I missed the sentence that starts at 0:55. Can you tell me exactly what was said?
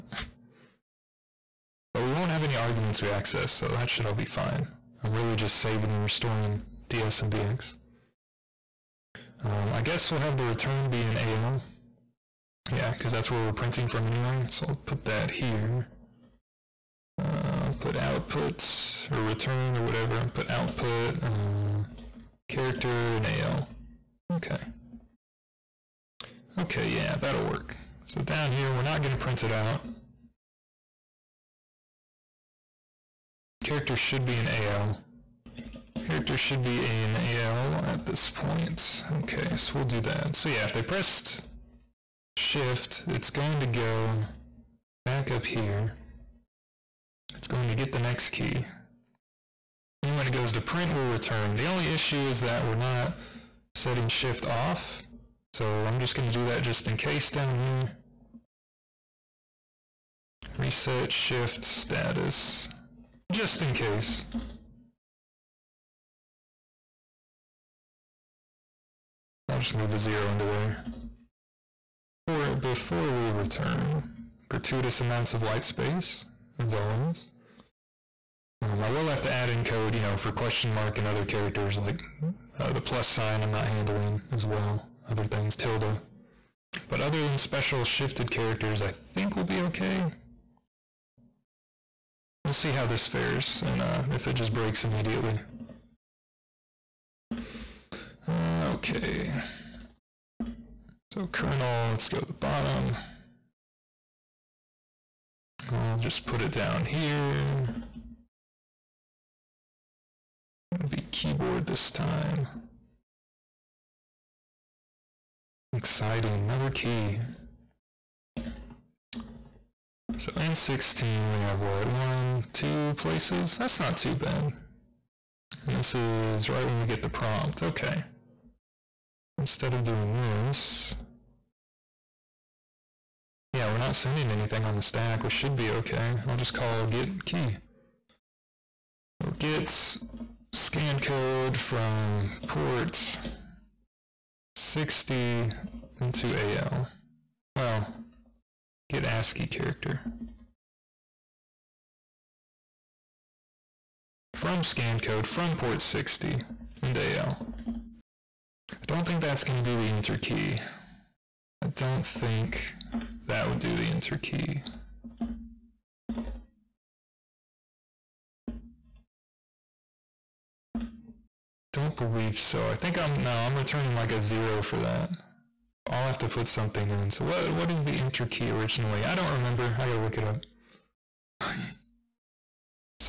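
So I'm just going to do that just in case down here.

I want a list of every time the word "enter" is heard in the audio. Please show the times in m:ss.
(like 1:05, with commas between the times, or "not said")
2:39, 2:43, 2:57.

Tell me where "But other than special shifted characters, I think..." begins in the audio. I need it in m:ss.
1:26.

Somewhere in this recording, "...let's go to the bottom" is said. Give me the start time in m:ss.
1:41.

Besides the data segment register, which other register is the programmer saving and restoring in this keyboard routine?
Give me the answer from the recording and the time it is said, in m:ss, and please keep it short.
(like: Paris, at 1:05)
BX, at 0:07.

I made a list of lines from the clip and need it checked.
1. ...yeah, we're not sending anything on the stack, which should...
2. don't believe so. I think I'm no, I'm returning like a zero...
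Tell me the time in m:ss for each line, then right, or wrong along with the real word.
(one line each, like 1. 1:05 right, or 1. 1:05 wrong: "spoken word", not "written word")
1. 2:13 right
2. 2:51 right.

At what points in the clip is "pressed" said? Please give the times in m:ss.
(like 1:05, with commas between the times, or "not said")
0:40.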